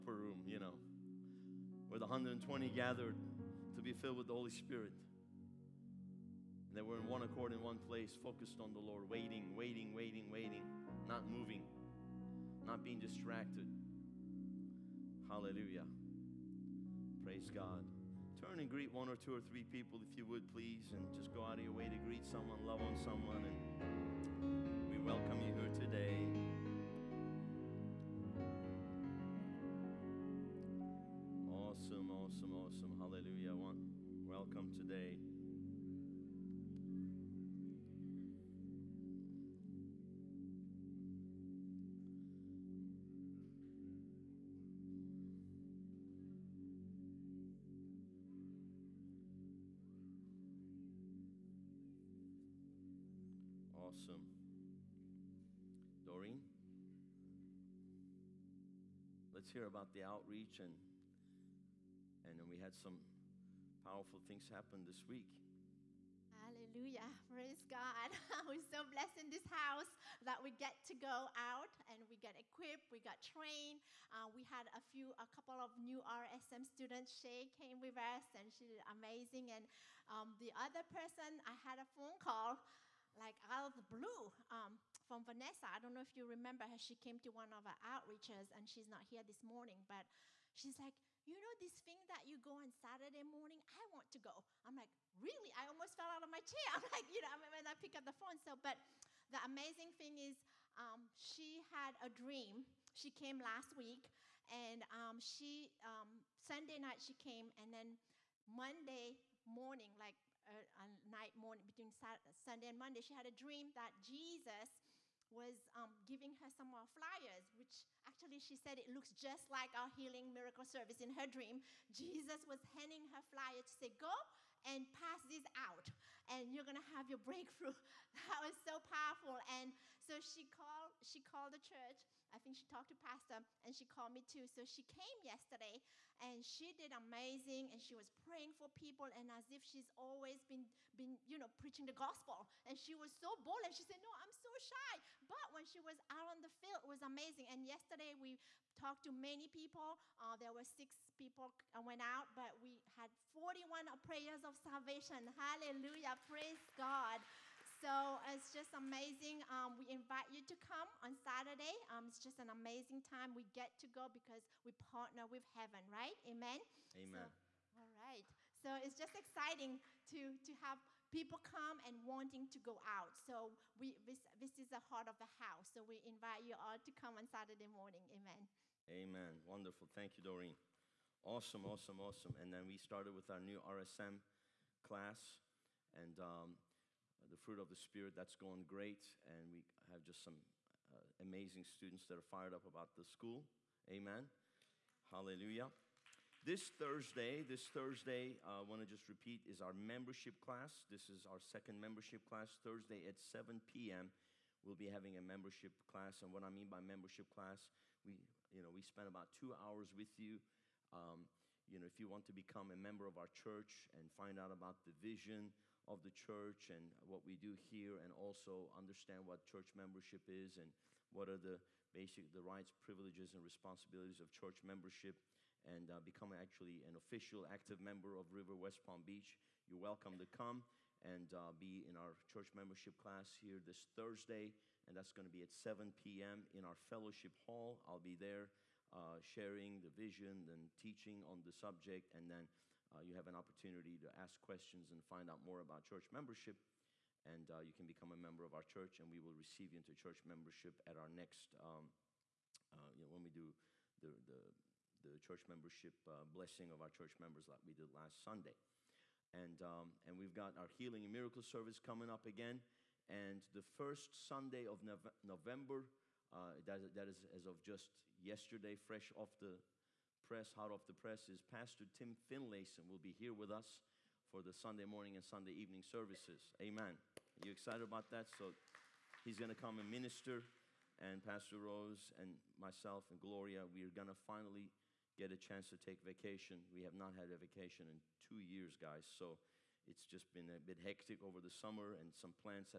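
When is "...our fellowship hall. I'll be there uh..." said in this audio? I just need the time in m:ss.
3:56.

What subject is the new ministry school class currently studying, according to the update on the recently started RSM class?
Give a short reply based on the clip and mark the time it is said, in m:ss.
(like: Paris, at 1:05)
The fruit of the Spirit, at 3:07.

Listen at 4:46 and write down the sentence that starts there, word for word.
We have not had a vacation in two years, guys.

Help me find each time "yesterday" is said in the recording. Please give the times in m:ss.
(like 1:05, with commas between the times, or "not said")
2:15, 2:27, 4:28.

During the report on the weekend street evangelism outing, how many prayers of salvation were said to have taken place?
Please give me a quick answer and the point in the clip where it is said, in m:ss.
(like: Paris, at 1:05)
41, at 2:33.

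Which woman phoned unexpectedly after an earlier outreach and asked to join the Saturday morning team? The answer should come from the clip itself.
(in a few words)
Vanessa.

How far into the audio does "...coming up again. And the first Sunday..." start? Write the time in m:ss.
4:21.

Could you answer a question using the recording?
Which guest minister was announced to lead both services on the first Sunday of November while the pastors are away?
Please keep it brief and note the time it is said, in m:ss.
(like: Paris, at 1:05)
Pastor Tim Finlayson, at 4:31.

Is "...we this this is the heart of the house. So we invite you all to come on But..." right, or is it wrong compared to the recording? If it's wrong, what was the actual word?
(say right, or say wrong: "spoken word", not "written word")
wrong: "Saturday", not "But".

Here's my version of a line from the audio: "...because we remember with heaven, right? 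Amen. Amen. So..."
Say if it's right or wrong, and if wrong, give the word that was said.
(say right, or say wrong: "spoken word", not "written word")
wrong: "partner", not "remember".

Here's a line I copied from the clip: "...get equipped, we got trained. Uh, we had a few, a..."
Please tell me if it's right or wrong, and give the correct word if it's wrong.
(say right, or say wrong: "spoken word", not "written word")
right.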